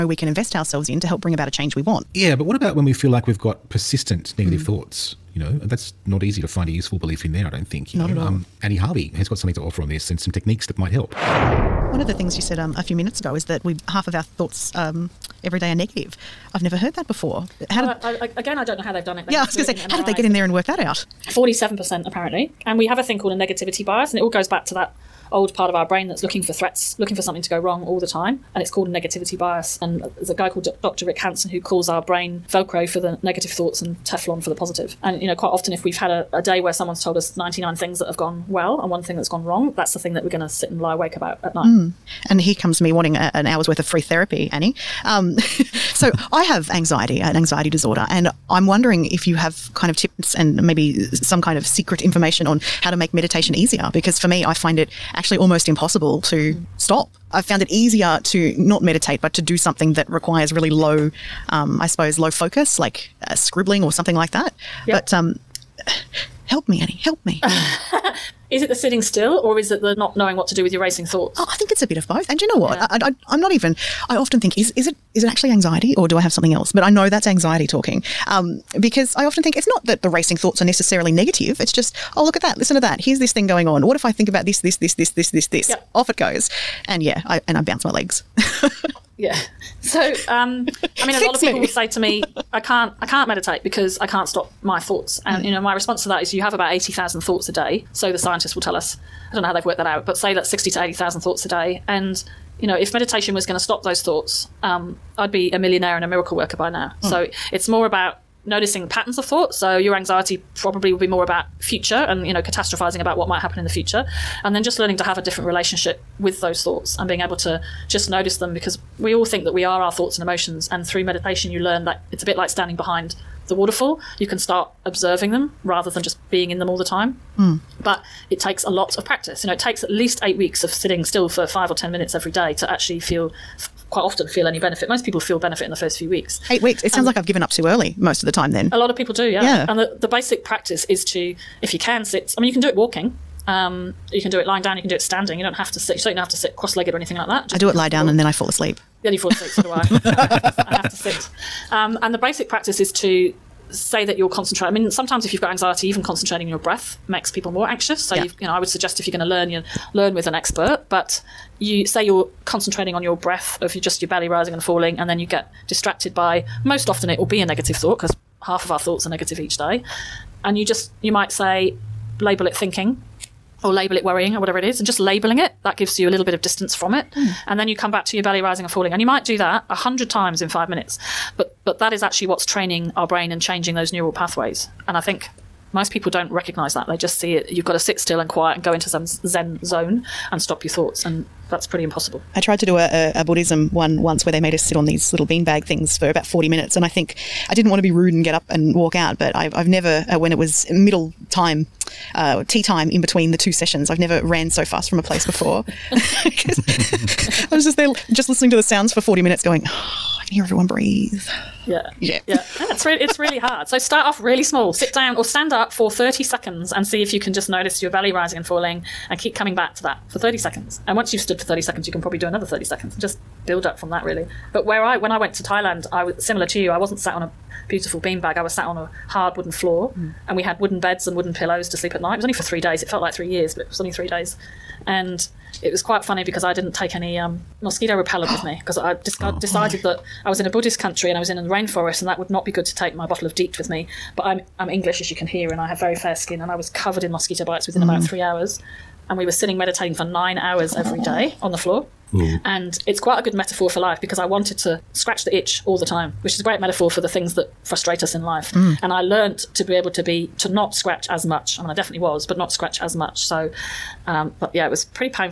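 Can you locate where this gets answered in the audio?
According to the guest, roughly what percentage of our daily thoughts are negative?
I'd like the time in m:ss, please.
0:21.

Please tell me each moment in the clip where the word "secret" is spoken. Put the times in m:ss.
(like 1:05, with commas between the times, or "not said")
0:51.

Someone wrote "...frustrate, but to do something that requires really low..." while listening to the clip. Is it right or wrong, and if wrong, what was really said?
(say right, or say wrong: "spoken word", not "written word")
wrong: "meditate", not "frustrate".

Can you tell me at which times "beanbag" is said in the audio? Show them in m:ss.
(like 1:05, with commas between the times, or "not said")
3:15, 3:47.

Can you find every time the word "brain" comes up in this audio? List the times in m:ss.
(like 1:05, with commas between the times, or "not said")
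0:25, 0:32, 3:03.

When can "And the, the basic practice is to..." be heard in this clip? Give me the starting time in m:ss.
2:19.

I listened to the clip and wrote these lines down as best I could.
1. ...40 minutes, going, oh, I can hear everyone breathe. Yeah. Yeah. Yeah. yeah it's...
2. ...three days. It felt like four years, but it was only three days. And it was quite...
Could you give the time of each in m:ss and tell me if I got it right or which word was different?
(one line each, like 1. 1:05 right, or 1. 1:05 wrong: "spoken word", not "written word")
1. 3:29 right
2. 3:52 wrong: "three", not "four".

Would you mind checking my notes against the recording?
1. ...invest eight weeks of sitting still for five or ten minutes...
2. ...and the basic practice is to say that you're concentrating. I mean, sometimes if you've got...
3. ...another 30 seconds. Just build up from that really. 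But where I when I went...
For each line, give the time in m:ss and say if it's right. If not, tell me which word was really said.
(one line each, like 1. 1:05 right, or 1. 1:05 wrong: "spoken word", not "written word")
1. 2:09 wrong: "least", not "invest"
2. 2:32 right
3. 3:42 right.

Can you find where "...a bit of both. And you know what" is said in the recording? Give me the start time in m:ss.
1:11.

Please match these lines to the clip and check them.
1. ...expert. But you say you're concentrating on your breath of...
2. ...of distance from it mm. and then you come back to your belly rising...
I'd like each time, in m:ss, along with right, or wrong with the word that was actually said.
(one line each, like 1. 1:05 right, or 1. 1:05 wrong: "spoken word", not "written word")
1. 2:40 right
2. 2:56 right.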